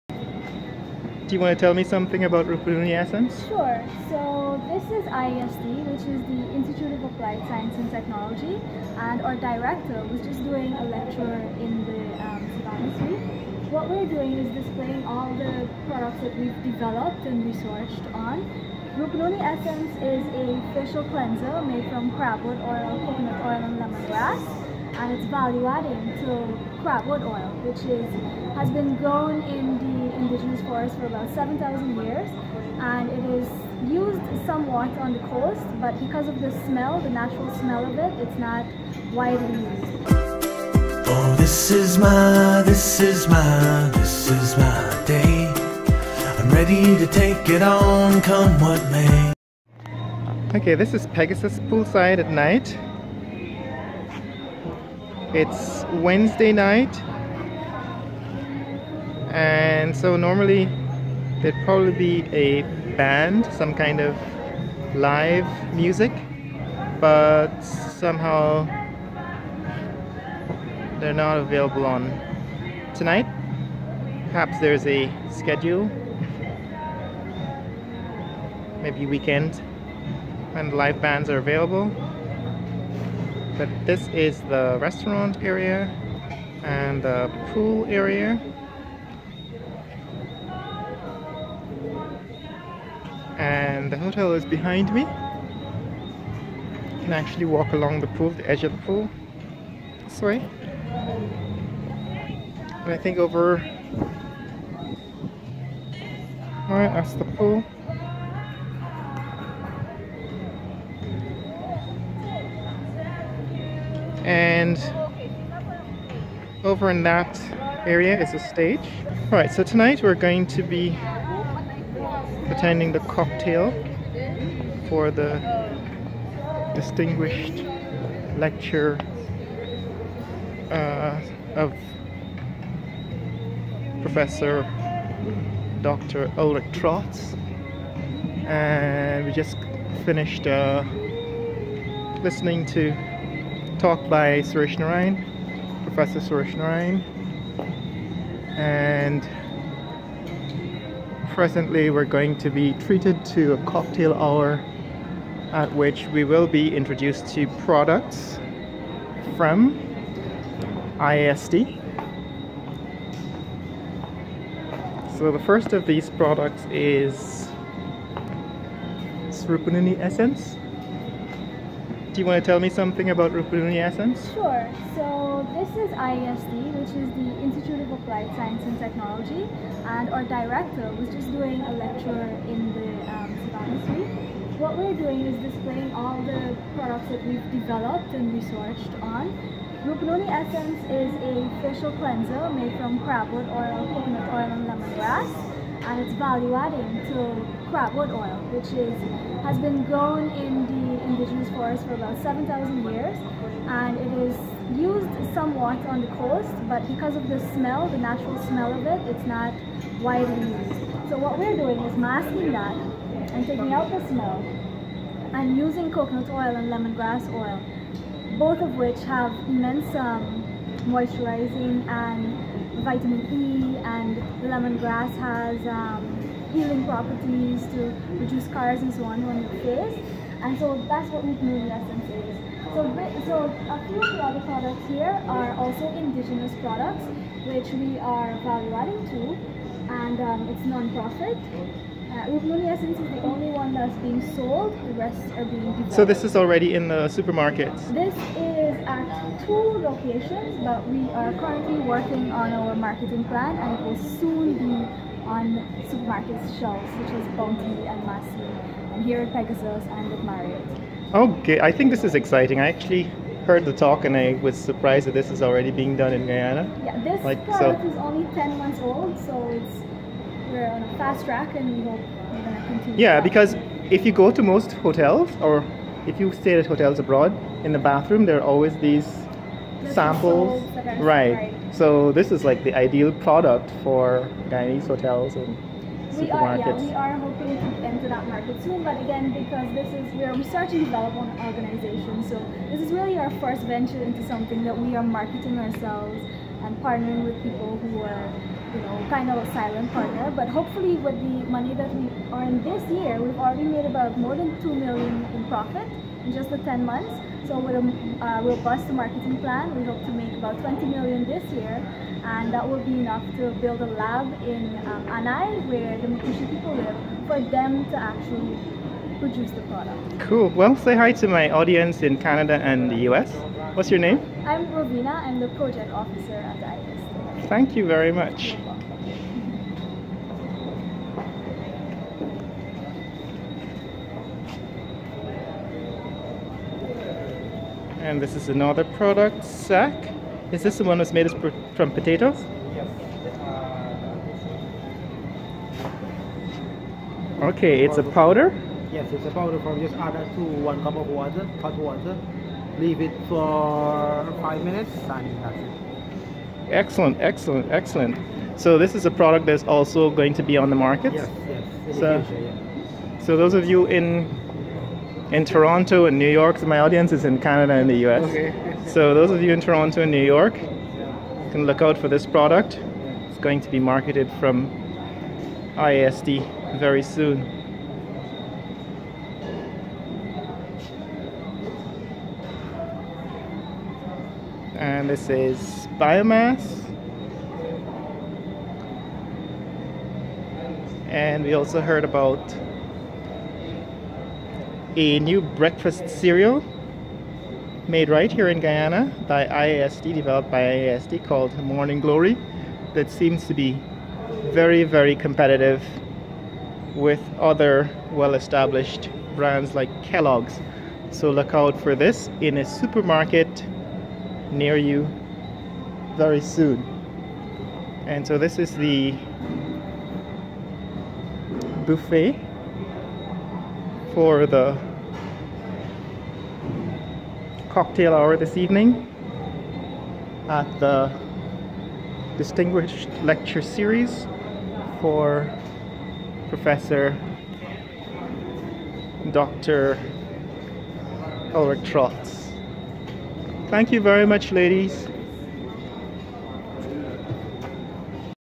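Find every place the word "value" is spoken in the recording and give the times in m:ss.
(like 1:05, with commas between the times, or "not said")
0:25, 3:16, 3:58.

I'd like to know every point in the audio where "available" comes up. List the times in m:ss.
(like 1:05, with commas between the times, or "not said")
1:11, 1:21.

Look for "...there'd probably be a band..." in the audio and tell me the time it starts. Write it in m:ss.
1:01.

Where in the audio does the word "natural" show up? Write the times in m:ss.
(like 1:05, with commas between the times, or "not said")
0:37, 3:27.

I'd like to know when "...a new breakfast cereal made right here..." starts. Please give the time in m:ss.
6:34.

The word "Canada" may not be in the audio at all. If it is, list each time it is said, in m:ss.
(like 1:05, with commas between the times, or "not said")
5:22, 6:07.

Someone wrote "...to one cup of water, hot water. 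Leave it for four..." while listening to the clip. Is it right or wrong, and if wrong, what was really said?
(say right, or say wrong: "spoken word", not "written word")
wrong: "five", not "four".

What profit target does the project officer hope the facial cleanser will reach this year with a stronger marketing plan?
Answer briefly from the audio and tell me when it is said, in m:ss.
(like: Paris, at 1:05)
20 million, at 5:10.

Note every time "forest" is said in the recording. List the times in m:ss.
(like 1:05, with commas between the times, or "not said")
0:30, 3:21.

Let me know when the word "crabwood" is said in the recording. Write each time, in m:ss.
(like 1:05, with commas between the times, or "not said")
0:22, 0:26, 3:13, 3:17.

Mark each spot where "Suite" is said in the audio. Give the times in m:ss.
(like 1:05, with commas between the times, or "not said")
0:12, 3:03.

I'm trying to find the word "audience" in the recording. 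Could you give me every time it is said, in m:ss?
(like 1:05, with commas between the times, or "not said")
5:21, 6:06.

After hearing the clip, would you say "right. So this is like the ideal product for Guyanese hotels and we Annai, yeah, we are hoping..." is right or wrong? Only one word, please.
wrong.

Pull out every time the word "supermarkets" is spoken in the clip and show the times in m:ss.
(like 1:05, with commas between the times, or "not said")
4:07, 4:15, 6:52.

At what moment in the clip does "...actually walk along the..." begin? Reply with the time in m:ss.
1:37.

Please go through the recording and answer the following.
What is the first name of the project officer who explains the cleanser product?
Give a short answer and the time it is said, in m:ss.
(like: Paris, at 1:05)
Robina, at 5:24.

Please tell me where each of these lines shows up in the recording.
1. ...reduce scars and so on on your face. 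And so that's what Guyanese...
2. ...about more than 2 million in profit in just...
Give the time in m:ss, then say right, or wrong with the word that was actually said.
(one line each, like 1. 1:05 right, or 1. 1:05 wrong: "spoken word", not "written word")
1. 3:48 wrong: "Rupununi", not "Guyanese"
2. 5:03 right.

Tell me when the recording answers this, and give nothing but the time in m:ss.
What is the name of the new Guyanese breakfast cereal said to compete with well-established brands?
6:41.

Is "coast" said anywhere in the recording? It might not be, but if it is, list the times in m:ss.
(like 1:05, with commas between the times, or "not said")
0:35, 3:26.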